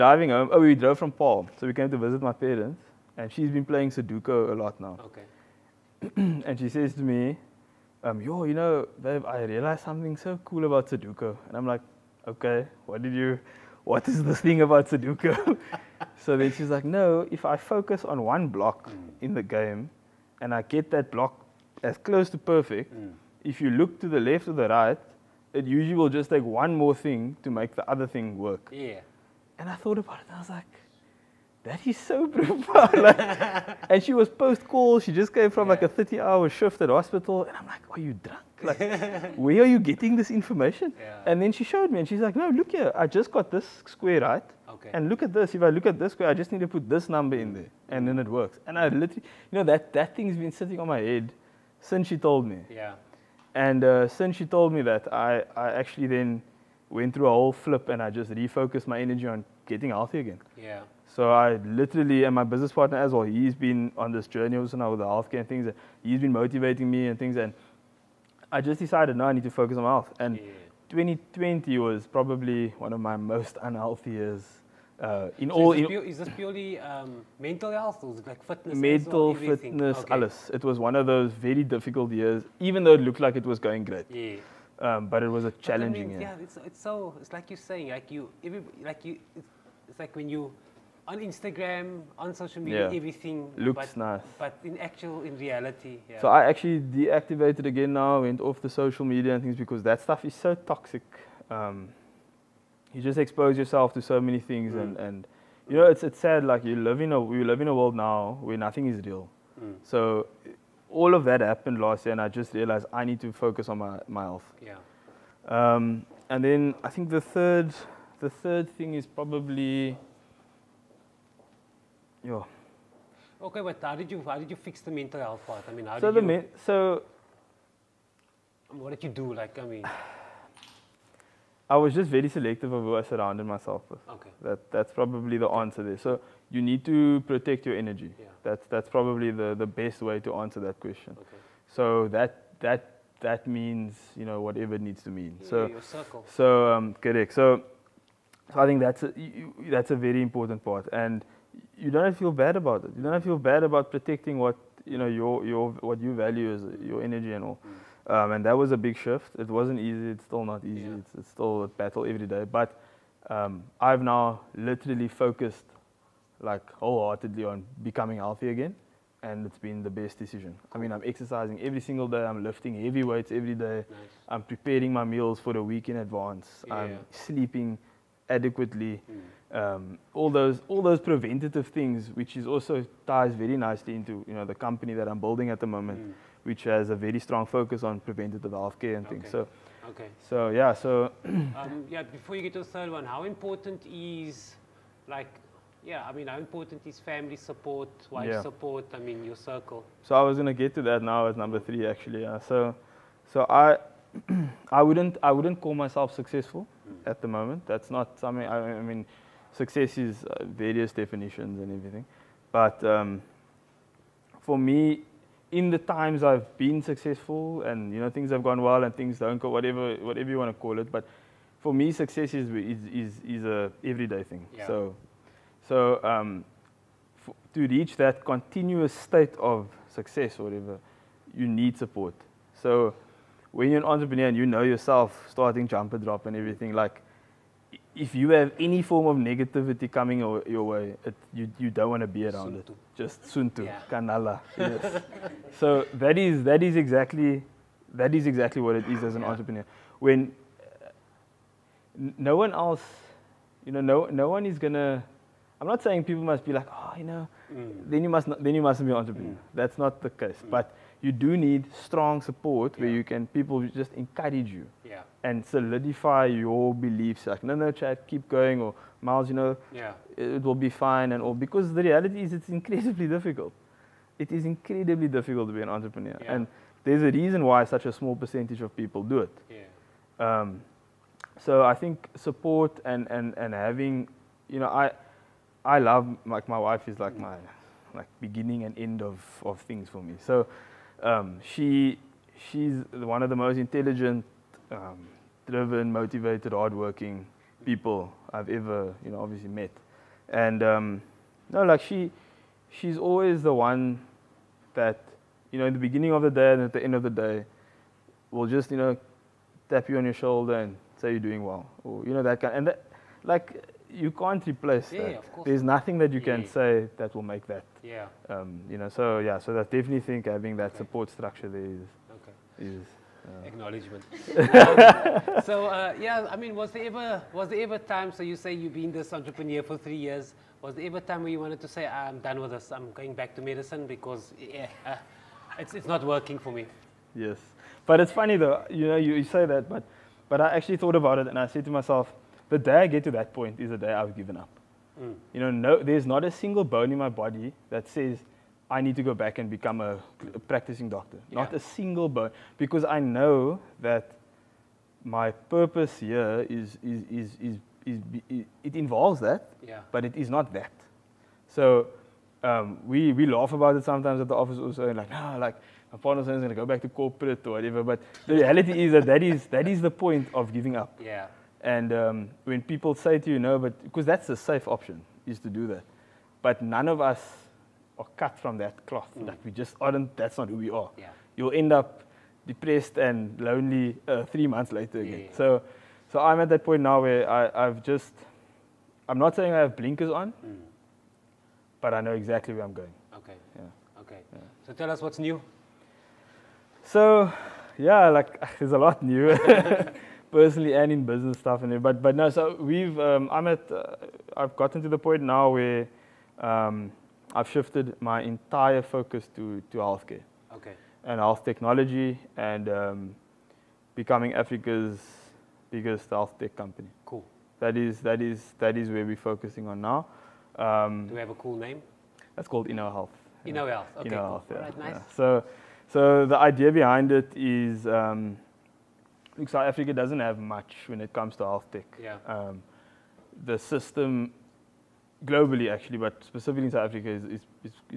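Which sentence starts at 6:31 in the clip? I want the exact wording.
but I know exactly where I'm going.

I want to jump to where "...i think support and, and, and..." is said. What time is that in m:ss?
4:41.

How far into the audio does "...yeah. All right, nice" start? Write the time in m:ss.
7:04.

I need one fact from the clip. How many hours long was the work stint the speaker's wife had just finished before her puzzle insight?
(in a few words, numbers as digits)
30.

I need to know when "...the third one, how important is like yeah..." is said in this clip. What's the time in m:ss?
3:12.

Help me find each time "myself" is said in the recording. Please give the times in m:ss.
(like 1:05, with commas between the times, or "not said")
2:13, 3:25, 5:41.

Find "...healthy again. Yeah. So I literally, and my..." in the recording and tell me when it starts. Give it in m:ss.
0:59.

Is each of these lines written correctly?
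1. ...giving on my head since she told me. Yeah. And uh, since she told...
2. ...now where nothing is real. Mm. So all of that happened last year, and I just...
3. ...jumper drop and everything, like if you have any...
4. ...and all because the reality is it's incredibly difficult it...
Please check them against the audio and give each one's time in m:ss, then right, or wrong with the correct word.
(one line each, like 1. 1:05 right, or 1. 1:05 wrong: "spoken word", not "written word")
1. 0:50 wrong: "sitting", not "giving"
2. 1:47 right
3. 3:55 right
4. 4:31 right.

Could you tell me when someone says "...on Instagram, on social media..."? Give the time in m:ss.
1:31.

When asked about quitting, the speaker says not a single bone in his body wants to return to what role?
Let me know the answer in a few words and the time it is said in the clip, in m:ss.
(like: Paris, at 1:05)
practicing doctor, at 5:50.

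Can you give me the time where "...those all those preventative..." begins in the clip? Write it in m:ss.
3:00.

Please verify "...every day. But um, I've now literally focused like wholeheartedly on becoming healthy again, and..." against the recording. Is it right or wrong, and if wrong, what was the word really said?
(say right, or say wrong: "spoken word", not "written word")
right.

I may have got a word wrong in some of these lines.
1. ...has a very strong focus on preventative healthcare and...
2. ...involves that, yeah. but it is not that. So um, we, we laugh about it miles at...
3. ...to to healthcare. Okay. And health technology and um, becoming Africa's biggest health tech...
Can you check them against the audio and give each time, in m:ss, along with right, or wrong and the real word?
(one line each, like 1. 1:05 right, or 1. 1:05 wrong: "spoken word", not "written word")
1. 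3:06 right
2. 5:58 wrong: "sometimes", not "miles"
3. 6:49 right.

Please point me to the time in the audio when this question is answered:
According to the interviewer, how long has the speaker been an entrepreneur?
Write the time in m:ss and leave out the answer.
5:29.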